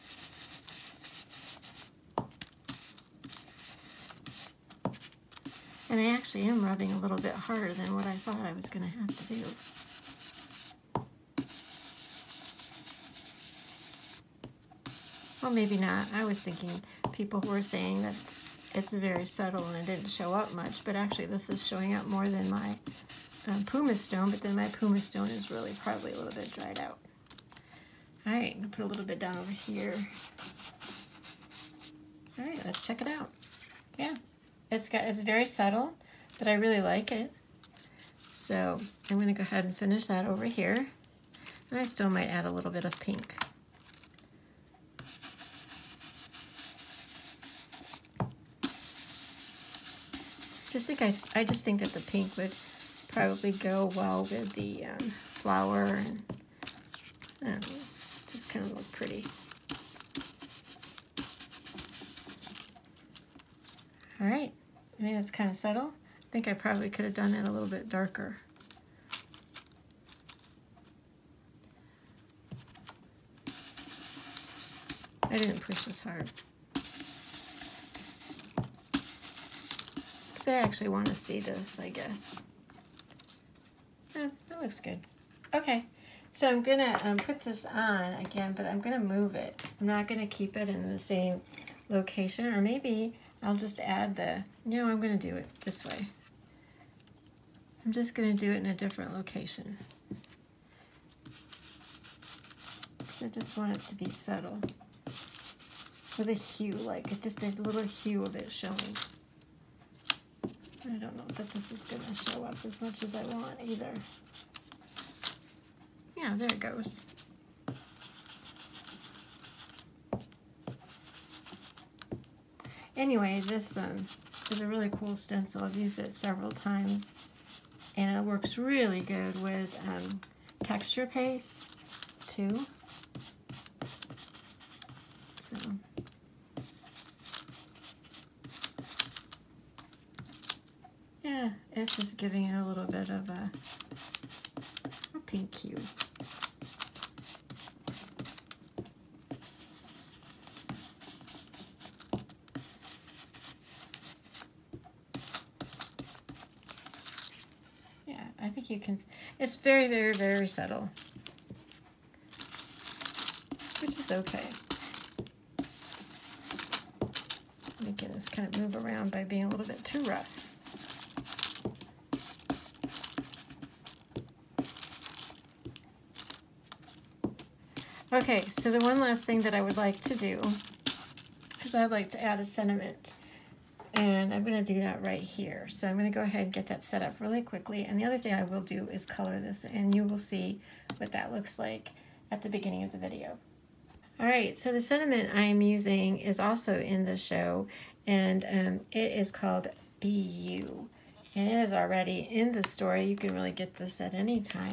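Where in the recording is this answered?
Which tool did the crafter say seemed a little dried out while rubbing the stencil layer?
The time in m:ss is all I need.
0:24.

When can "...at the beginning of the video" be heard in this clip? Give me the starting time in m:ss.
3:12.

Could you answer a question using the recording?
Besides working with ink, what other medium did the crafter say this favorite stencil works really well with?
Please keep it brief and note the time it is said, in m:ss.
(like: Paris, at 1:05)
Texture paste, at 2:10.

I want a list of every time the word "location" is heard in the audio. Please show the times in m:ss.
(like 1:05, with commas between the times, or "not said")
1:31, 1:39.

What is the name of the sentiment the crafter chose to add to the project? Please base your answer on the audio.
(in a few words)
Be You.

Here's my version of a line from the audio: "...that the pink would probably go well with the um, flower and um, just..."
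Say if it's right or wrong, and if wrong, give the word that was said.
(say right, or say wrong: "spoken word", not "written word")
right.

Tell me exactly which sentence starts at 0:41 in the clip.
And I still might add a little bit of pink.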